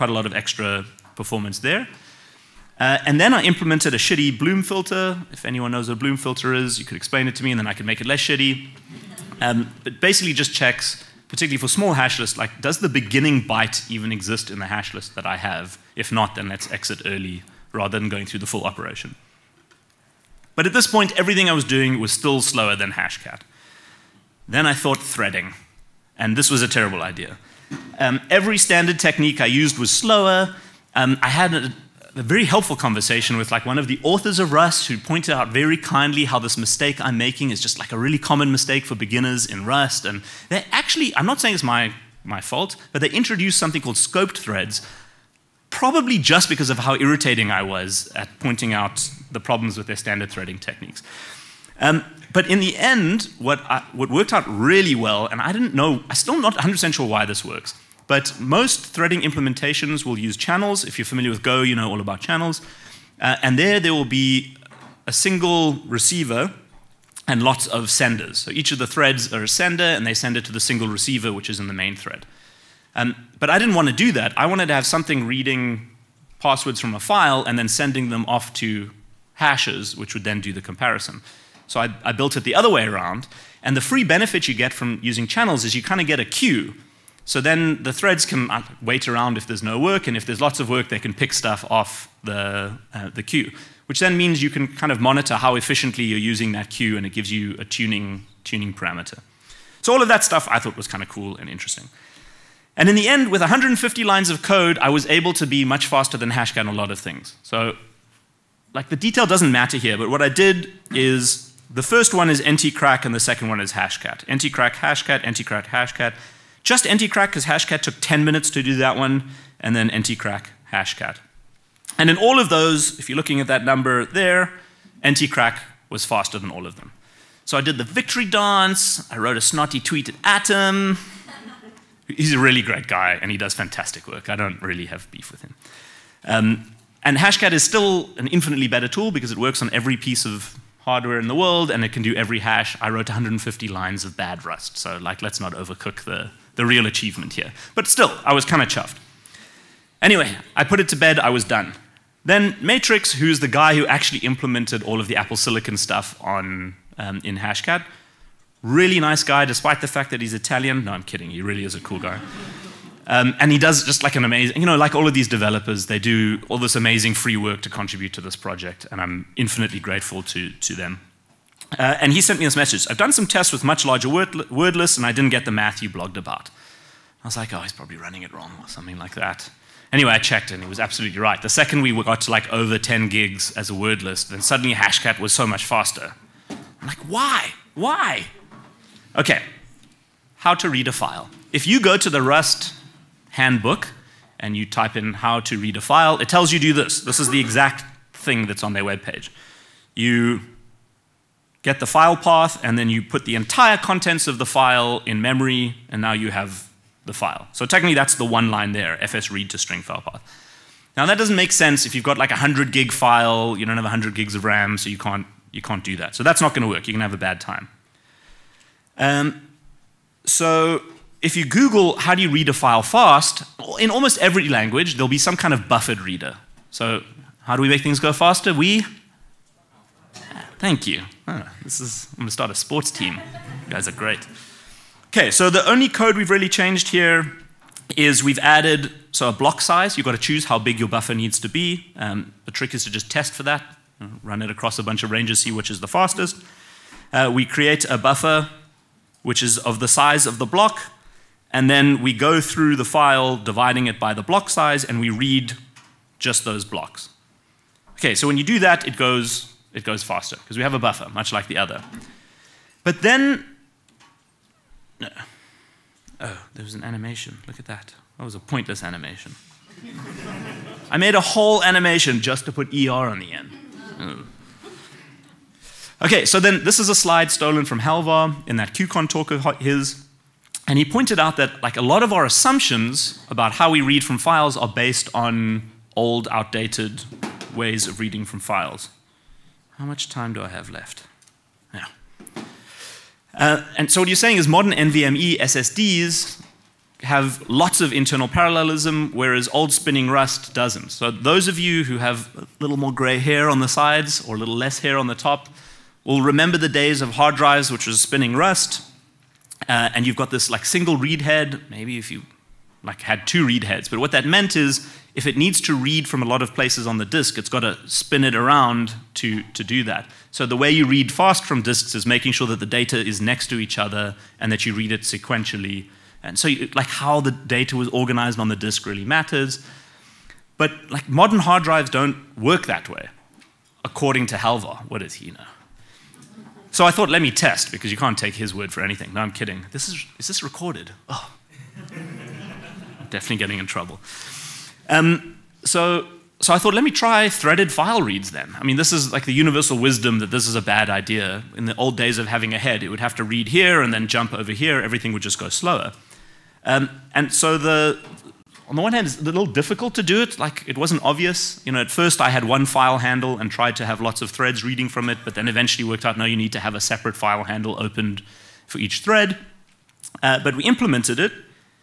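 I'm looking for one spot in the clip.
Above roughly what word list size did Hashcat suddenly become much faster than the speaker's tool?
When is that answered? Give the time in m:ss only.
3:02.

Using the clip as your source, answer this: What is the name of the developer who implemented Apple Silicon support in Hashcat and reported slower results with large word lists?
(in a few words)
Matrix.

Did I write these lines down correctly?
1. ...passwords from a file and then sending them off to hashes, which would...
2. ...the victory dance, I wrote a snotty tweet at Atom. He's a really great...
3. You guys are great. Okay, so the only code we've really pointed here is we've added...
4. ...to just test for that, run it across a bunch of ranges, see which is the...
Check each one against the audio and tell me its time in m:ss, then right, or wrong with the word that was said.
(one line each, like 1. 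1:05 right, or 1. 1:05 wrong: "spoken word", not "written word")
1. 1:16 right
2. 2:07 right
3. 3:53 wrong: "changed", not "pointed"
4. 4:02 right.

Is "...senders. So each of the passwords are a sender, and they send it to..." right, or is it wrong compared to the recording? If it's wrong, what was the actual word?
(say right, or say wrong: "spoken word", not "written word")
wrong: "threads", not "passwords".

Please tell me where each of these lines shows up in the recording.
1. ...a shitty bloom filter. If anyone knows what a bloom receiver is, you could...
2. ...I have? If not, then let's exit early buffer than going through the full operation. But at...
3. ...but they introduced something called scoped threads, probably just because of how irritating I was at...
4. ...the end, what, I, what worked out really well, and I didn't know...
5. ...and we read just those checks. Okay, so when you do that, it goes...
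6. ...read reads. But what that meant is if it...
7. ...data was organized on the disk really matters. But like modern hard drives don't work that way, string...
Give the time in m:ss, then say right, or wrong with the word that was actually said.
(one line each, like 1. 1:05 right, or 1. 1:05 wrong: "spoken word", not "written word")
1. 0:03 wrong: "filter", not "receiver"
2. 0:15 wrong: "rather", not "buffer"
3. 0:42 right
4. 0:52 right
5. 4:14 wrong: "blocks", not "checks"
6. 5:13 wrong: "heads", not "reads"
7. 5:27 wrong: "according", not "string".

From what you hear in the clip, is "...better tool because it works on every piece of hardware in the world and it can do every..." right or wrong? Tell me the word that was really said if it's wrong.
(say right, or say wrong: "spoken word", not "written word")
right.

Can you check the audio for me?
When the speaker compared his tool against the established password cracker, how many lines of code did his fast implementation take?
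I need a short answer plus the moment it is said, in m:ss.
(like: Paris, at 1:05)
150, at 1:43.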